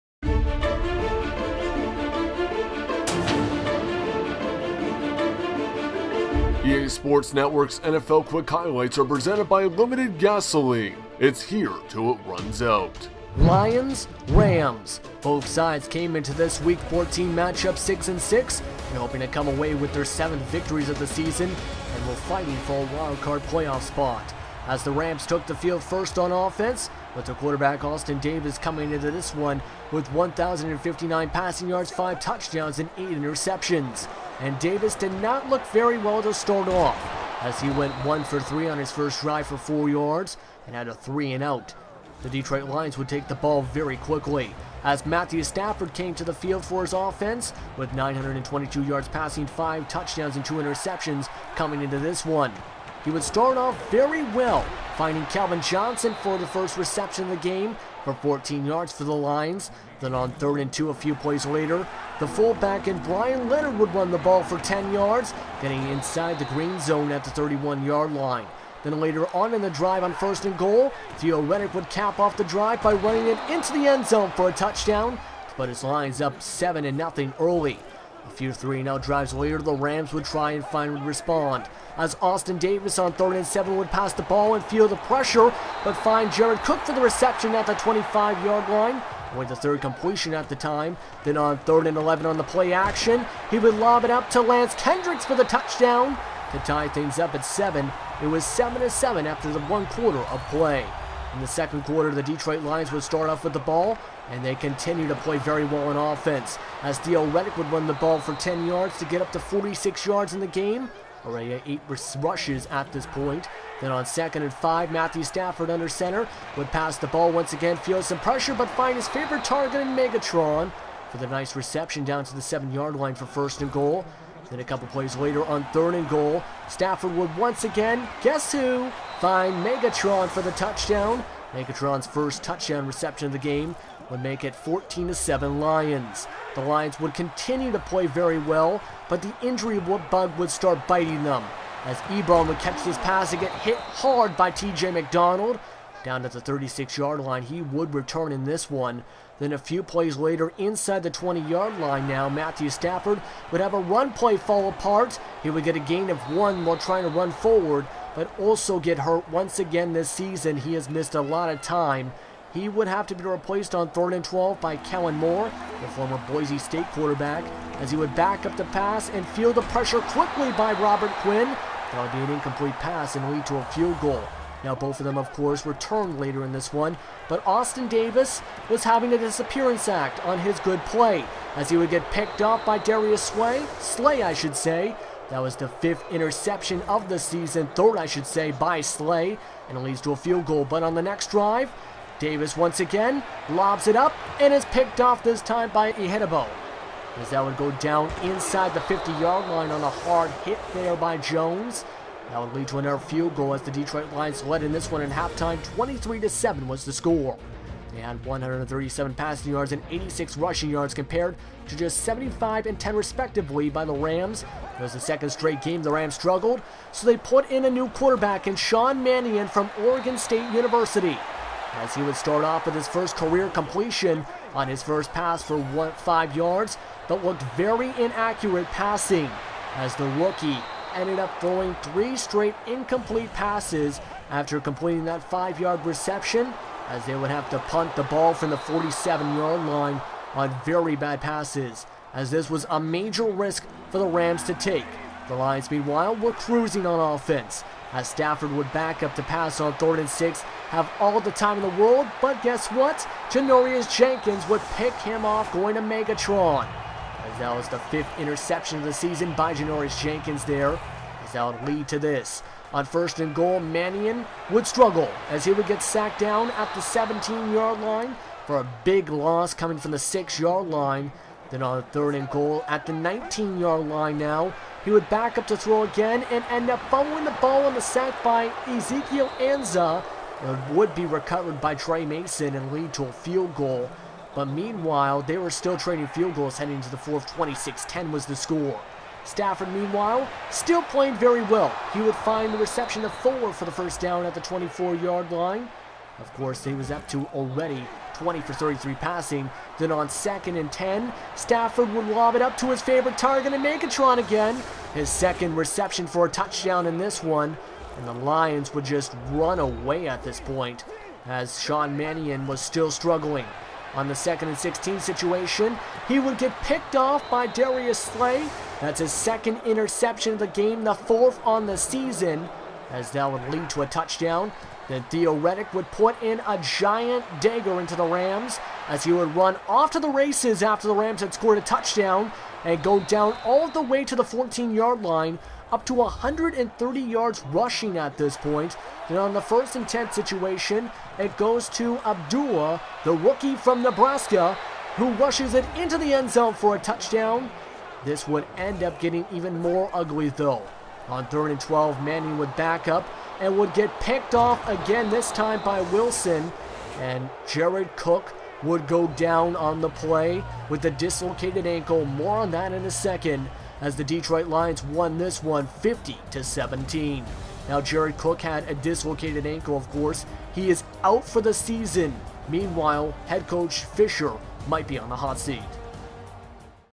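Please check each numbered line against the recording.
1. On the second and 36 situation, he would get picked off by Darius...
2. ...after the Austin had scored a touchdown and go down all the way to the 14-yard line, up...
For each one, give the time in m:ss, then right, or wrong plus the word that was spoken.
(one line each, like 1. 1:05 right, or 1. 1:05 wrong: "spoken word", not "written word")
1. 5:13 wrong: "16", not "36"
2. 5:30 wrong: "Rams", not "Austin".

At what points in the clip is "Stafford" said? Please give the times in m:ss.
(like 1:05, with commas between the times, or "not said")
0:45, 1:55, 2:06, 2:32, 4:08, 4:49, 5:01.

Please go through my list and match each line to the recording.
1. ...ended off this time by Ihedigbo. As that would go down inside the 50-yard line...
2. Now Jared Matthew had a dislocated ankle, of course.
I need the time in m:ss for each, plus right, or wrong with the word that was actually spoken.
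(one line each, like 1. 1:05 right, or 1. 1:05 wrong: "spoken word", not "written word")
1. 3:14 wrong: "picked", not "ended"
2. 6:07 wrong: "Cook", not "Matthew".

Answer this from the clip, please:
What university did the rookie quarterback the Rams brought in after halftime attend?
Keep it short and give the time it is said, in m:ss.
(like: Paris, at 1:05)
Oregon State University, at 3:39.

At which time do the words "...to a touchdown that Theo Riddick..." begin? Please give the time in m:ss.
5:23.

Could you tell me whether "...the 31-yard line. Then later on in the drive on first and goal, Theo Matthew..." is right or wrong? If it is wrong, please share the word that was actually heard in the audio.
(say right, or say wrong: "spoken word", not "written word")
wrong: "Riddick", not "Matthew".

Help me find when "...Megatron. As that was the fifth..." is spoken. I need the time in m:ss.
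4:15.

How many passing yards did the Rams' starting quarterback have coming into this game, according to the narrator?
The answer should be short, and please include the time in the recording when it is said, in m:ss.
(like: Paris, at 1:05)
1,059, at 0:30.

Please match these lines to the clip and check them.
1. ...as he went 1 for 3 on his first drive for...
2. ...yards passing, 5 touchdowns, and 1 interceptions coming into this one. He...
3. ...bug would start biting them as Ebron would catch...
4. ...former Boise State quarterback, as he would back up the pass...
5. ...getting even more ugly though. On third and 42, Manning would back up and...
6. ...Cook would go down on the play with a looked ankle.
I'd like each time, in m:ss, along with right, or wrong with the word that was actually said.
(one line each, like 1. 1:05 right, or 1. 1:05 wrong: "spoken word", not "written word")
1. 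0:37 right
2. 0:48 wrong: "2", not "1"
3. 2:19 right
4. 2:45 right
5. 5:48 wrong: "12", not "42"
6. 5:57 wrong: "dislocated", not "looked".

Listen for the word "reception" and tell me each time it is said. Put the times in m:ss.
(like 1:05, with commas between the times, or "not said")
0:56, 1:27, 2:01, 2:12, 3:55, 4:52, 5:05.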